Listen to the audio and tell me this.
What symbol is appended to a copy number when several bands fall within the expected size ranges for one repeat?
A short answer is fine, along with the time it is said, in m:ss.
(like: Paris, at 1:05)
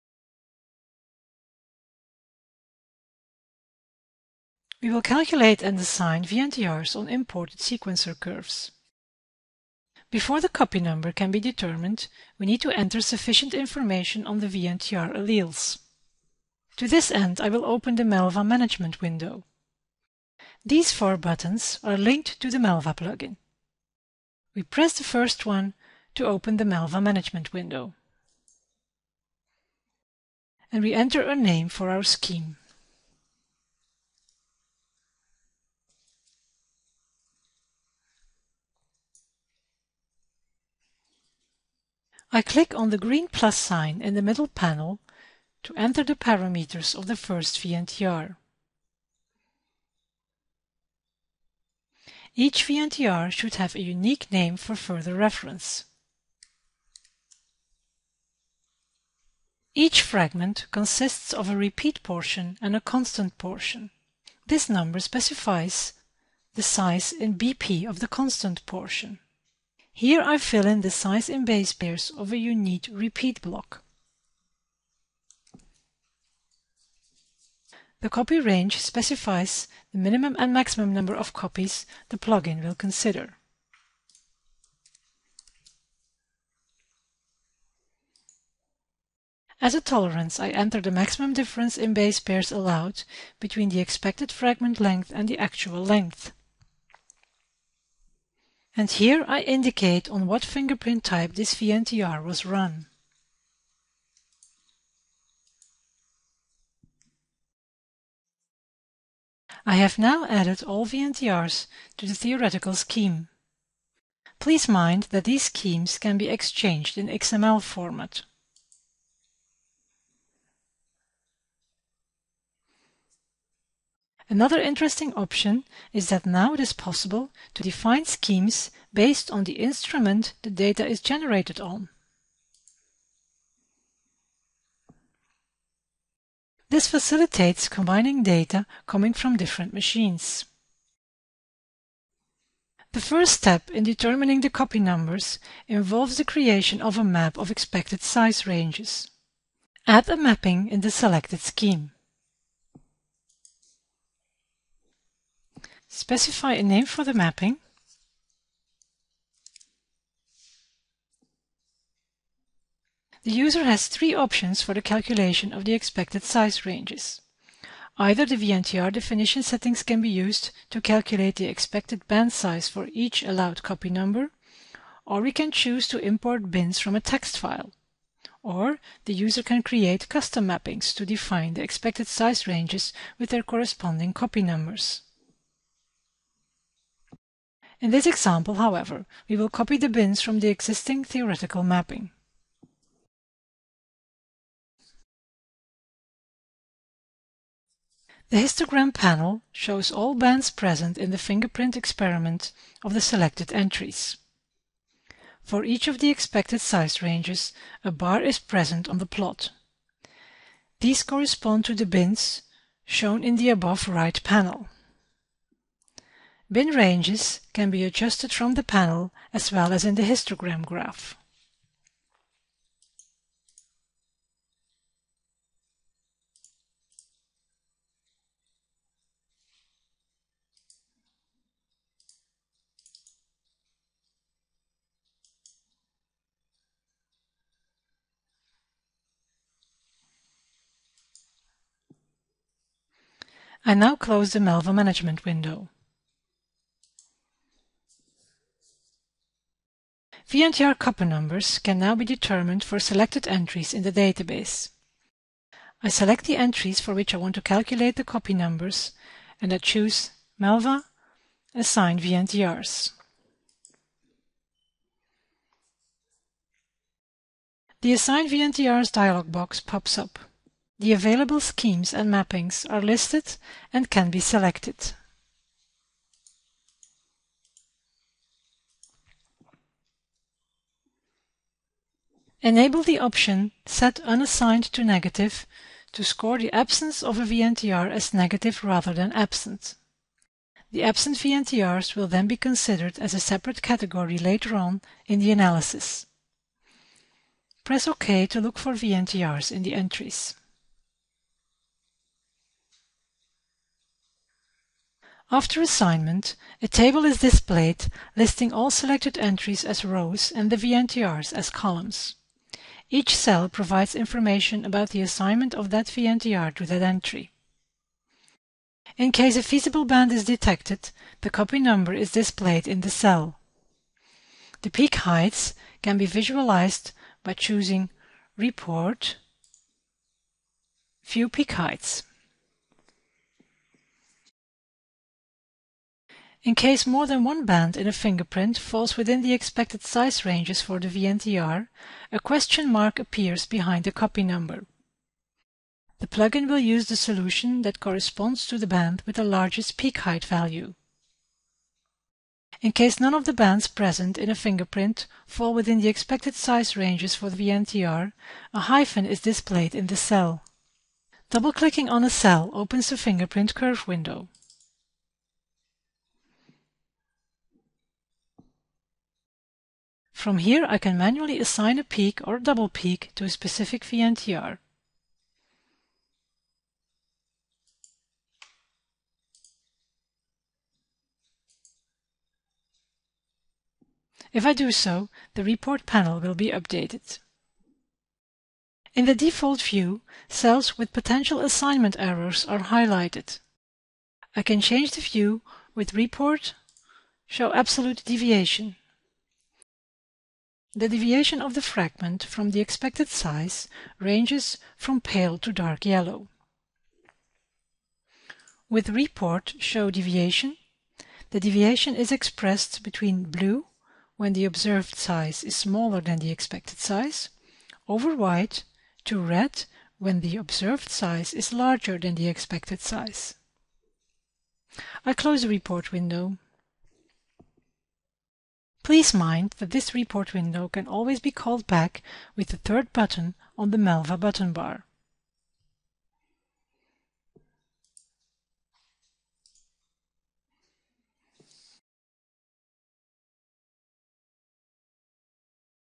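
A question mark, at 5:42.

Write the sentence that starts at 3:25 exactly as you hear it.
For each of the expected size ranges, a bar is present on the plot.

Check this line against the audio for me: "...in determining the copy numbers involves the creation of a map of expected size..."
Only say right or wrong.
right.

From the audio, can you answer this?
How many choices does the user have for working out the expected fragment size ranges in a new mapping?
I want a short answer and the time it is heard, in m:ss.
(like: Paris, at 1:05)
3, at 2:43.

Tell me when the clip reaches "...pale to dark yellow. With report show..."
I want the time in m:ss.
6:45.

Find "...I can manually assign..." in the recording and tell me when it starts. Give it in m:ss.
6:10.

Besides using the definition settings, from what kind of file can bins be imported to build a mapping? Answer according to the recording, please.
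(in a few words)
A text file.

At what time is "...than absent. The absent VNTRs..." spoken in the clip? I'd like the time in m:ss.
4:48.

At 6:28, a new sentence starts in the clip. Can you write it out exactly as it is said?
In the default view, cells with potential assignment errors are highlighted.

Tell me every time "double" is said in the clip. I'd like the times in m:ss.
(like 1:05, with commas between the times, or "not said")
6:01, 6:12.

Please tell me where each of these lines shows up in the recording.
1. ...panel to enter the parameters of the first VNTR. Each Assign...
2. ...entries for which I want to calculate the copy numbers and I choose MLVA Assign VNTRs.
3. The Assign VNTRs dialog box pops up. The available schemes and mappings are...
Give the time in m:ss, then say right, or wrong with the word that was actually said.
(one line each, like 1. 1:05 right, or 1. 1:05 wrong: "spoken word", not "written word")
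1. 0:44 wrong: "VNTR", not "Assign"
2. 4:16 right
3. 4:27 right.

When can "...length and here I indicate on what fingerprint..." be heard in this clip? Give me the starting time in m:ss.
1:35.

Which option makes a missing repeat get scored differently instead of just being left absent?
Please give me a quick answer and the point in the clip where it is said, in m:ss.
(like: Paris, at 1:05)
Set Unassigned to Negative, at 4:43.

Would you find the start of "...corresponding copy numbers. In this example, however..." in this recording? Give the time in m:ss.
3:03.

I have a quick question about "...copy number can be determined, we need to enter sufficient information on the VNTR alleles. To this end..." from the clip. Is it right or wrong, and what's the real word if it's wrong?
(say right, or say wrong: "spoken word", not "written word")
right.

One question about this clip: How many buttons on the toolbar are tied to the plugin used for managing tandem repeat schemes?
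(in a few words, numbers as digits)
4.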